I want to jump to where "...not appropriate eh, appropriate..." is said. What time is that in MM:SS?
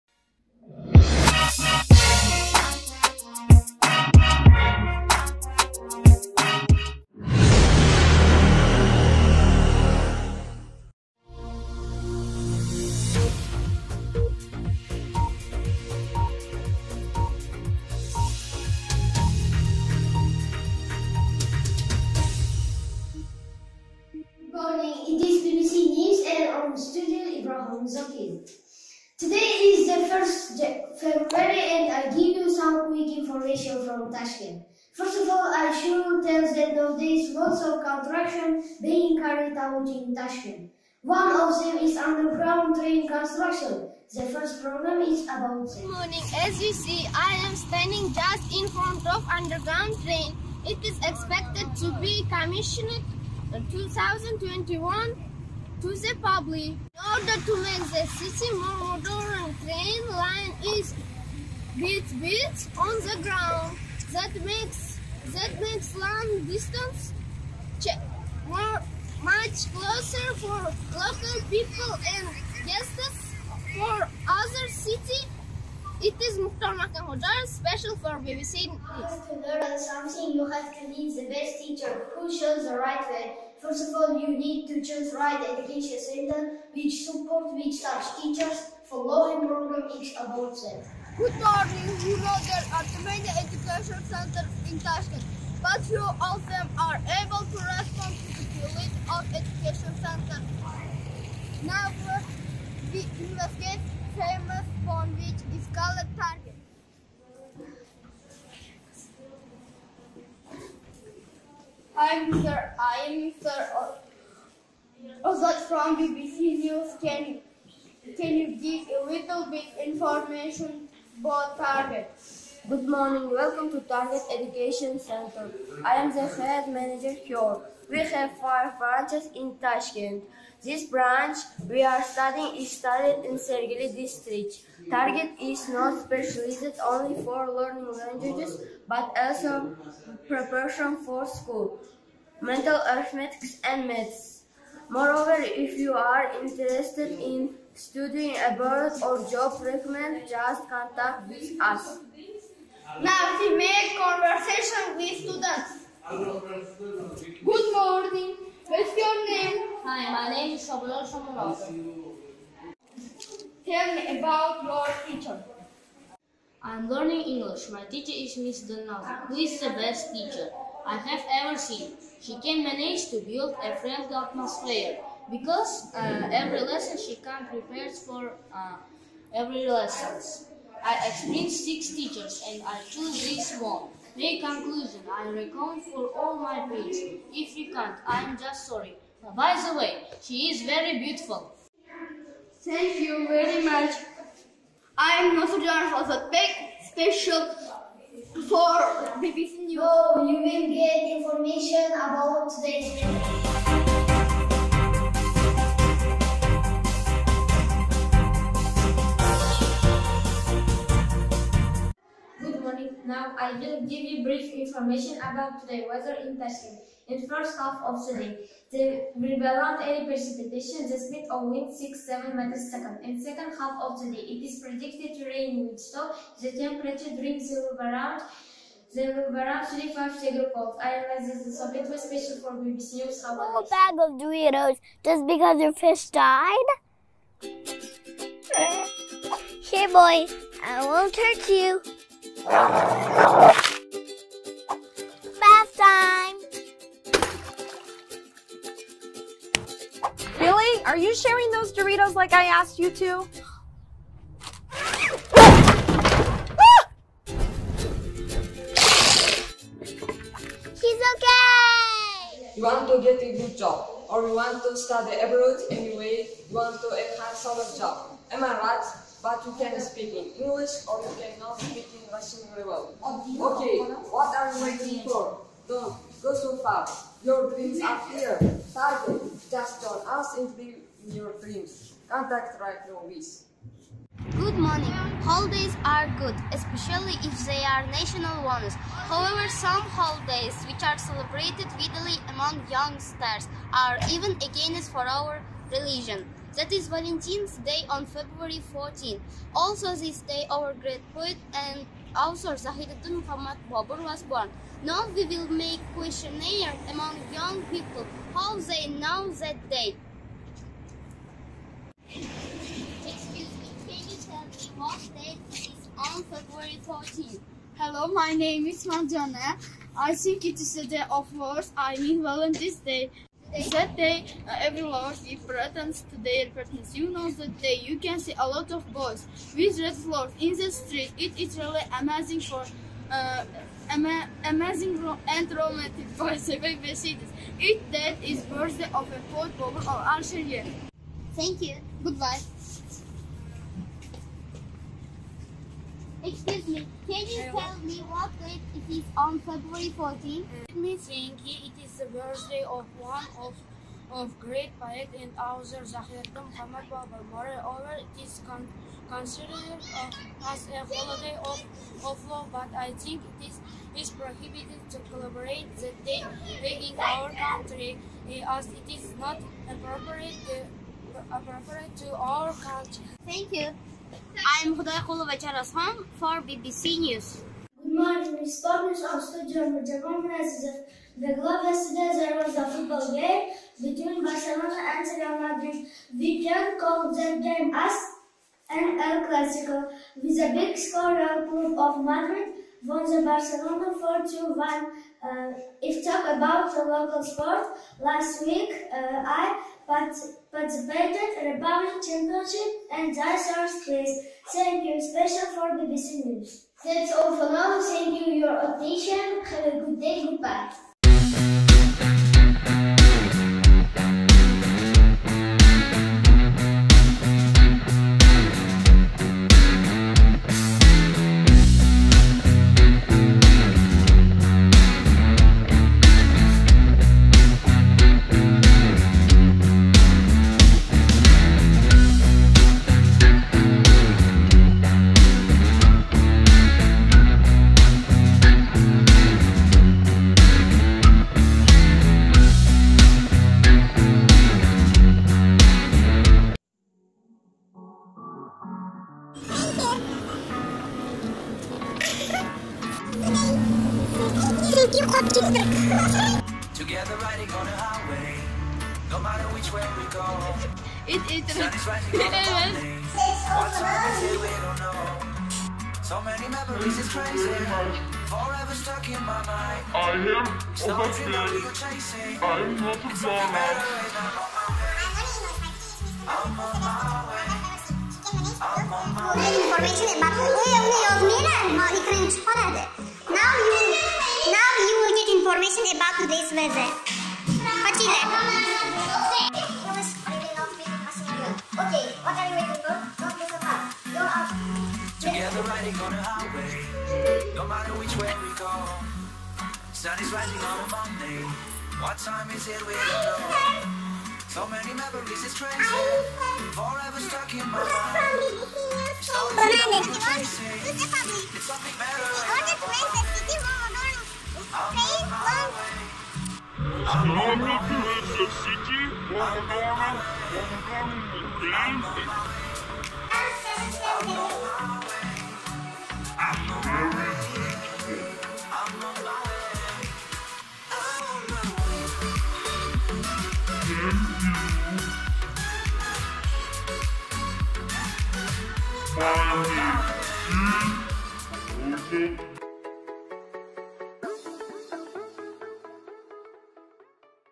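06:09.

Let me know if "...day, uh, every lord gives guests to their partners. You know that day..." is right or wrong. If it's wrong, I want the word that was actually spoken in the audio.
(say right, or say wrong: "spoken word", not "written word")
wrong: "presents", not "guests".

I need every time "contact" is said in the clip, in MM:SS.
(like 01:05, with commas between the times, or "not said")
02:30, 04:42.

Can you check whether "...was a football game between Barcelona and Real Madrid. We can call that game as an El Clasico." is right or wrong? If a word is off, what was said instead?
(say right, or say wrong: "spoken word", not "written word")
right.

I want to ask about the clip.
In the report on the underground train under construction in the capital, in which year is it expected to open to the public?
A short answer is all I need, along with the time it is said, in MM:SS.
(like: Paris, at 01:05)
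2021, at 00:53.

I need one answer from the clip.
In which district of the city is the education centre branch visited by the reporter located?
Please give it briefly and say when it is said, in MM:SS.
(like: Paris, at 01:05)
Sergeli, at 02:13.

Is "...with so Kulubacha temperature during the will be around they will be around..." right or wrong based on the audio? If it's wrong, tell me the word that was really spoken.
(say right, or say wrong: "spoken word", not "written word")
wrong: "The", not "Kulubacha".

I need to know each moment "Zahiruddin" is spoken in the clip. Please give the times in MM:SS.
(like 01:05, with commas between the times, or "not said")
05:02, 05:55.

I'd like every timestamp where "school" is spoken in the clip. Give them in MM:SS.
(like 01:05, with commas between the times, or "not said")
02:21.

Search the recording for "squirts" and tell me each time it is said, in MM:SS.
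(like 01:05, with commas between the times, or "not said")
not said.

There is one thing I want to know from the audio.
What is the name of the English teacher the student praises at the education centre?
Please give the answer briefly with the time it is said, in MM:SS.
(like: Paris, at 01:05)
Miss Donovan, at 02:48.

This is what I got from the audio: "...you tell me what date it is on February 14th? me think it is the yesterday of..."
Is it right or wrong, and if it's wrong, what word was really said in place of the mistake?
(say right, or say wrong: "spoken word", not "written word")
wrong: "birthday", not "yesterday".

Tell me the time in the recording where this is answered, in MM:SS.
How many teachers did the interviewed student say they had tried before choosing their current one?
03:01.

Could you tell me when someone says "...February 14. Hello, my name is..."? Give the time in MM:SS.
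05:16.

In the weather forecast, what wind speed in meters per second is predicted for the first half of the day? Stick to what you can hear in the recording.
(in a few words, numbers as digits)
6-7.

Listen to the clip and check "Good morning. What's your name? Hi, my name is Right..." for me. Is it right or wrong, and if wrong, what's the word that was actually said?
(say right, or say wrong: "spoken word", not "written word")
wrong: "Shabalol", not "Right".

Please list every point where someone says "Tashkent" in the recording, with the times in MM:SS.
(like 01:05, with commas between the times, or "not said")
00:34, 00:40, 01:34, 02:09, 03:36.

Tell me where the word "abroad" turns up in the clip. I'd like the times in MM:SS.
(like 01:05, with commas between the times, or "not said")
02:28, 04:25.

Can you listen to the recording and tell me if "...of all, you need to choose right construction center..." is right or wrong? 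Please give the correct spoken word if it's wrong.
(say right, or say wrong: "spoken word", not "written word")
wrong: "education", not "construction".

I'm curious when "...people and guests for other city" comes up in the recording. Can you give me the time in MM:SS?
01:11.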